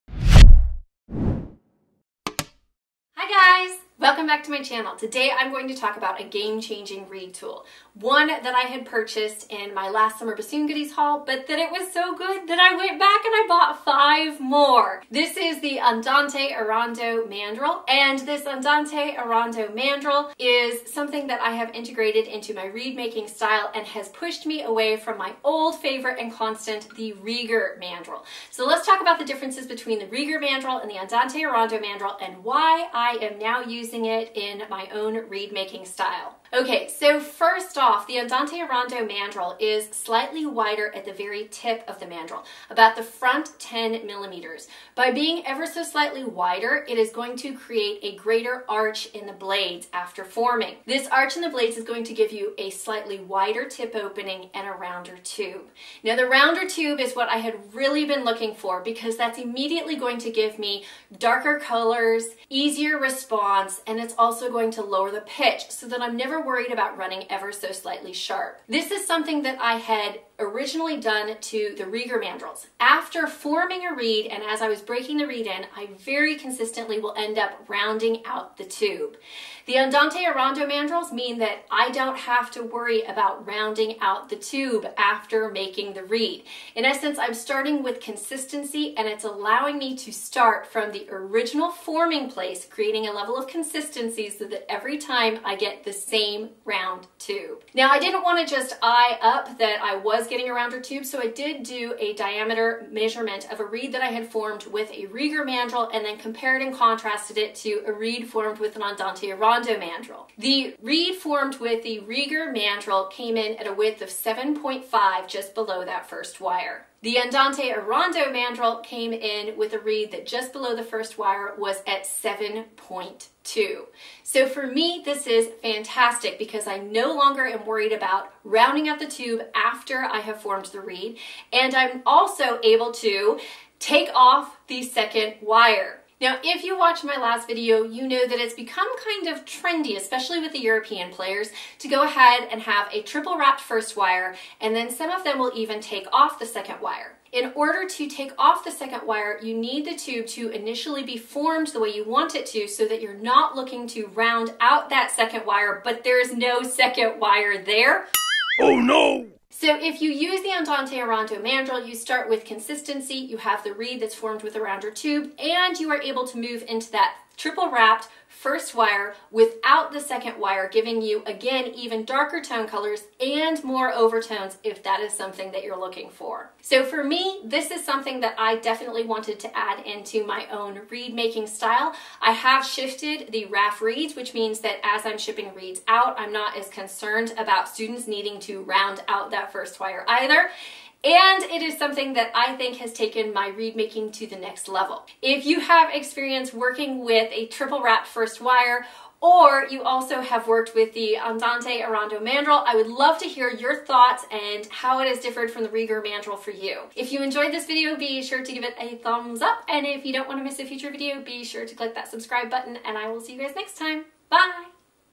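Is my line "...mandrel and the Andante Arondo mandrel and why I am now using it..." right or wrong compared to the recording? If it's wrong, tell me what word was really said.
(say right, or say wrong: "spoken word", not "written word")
right.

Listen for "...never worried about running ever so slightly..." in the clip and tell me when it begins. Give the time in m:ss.
1:06.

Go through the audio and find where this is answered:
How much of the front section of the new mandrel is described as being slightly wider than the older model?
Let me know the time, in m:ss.
0:43.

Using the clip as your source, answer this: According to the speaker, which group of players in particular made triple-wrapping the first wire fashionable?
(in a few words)
European players.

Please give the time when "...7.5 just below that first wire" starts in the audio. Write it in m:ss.
1:54.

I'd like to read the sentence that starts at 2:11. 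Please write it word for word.
And I'm also able to take off the second wire.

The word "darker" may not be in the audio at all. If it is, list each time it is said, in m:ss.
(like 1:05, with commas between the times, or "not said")
1:01, 2:52.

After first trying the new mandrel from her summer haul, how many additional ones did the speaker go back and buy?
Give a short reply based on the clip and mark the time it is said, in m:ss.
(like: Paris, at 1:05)
5, at 0:14.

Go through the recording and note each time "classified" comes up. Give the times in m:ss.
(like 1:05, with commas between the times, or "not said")
not said.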